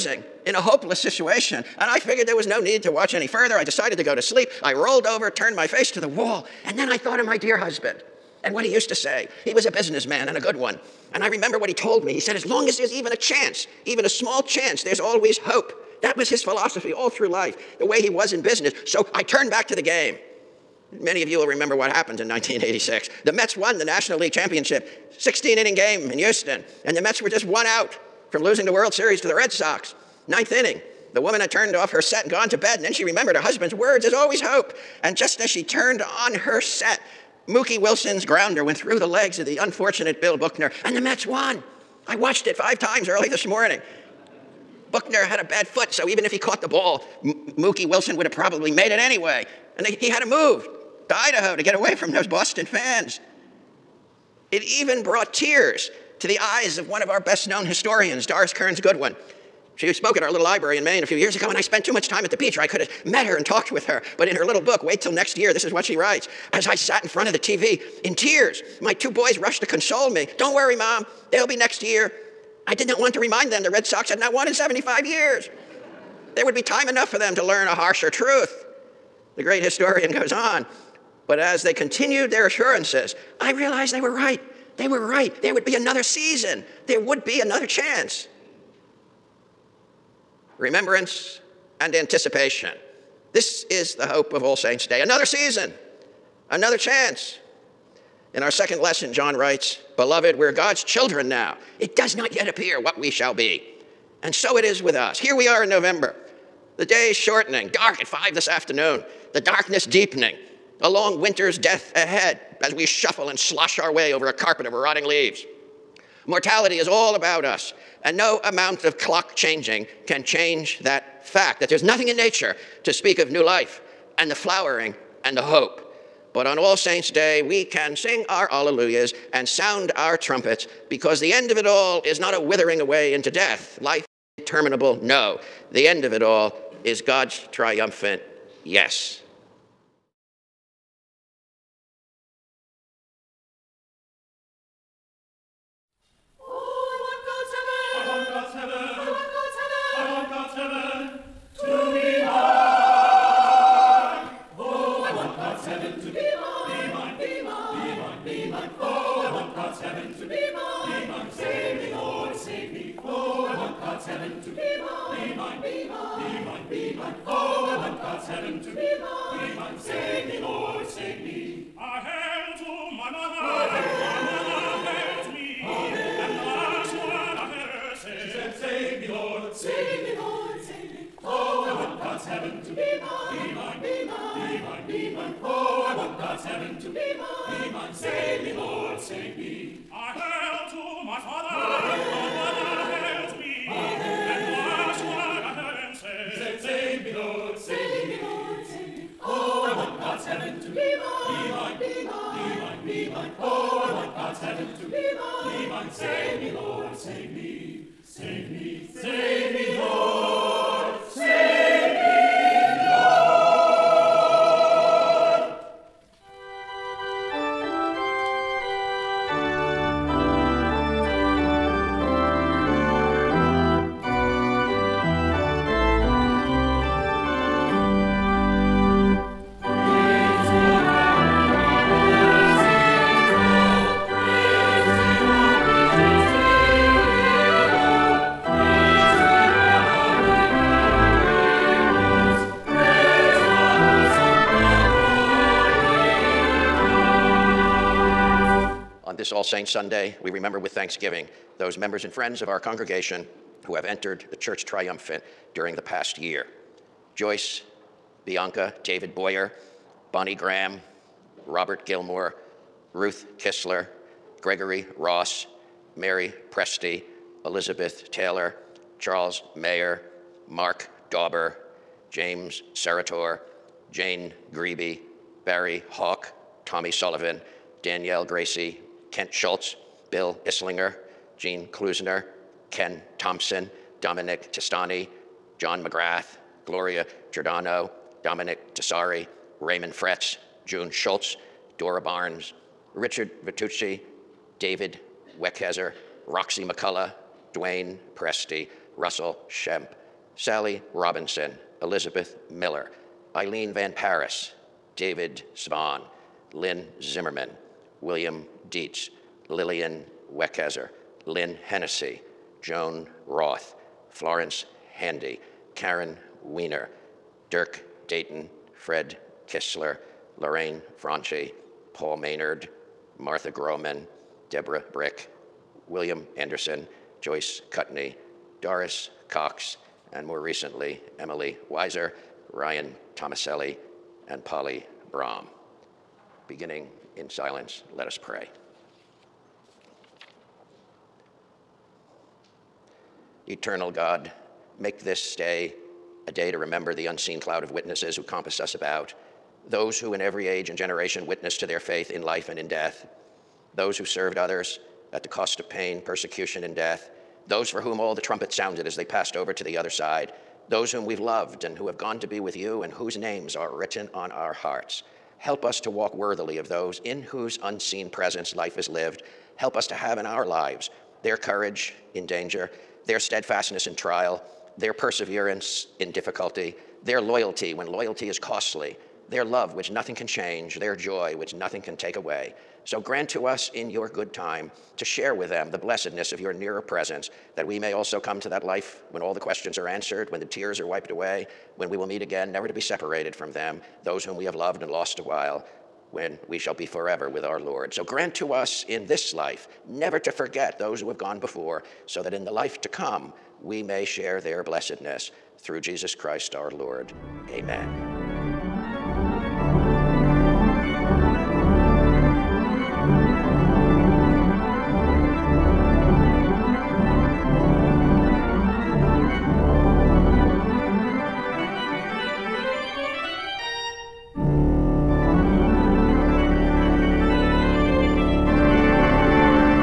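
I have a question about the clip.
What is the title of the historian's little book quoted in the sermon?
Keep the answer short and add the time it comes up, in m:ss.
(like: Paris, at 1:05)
Wait Till Next Year, at 1:04.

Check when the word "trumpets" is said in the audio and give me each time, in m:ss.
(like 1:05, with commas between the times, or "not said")
2:10, 5:58.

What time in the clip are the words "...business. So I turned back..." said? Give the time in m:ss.
0:18.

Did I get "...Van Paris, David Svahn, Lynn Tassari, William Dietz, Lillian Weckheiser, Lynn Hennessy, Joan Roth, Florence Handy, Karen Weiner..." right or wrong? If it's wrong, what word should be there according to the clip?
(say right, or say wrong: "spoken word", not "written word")
wrong: "Zimmerman", not "Tassari".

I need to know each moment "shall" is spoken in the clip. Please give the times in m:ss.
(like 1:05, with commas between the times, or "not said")
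1:43, 6:36.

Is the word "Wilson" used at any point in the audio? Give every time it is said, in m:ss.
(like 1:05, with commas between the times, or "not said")
0:37, 0:47.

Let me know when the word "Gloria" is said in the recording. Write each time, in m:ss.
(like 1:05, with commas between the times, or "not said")
4:46.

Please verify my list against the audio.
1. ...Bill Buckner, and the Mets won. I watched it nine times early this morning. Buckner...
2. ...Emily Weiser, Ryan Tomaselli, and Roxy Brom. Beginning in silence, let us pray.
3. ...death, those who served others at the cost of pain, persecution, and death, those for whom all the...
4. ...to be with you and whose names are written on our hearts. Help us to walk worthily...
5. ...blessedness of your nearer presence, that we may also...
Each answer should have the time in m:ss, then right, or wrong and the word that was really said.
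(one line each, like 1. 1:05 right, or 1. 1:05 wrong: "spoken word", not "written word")
1. 0:40 wrong: "five", not "nine"
2. 5:31 wrong: "Polly", not "Roxy"
3. 5:52 right
4. 6:02 right
5. 6:25 right.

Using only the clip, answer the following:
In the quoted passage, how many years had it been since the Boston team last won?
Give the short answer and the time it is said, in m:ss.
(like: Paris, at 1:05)
75, at 1:14.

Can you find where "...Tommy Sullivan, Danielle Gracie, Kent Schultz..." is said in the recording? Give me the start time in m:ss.
4:36.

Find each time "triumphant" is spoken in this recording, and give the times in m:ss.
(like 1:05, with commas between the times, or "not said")
2:17, 4:14.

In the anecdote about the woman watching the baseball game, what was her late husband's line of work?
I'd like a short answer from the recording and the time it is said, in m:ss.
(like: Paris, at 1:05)
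businessman, at 0:09.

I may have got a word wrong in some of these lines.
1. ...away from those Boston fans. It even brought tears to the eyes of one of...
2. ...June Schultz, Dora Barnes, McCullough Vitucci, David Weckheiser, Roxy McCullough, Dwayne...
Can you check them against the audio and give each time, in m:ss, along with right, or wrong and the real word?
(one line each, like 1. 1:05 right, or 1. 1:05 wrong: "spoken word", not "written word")
1. 0:51 right
2. 4:50 wrong: "Richard", not "McCullough".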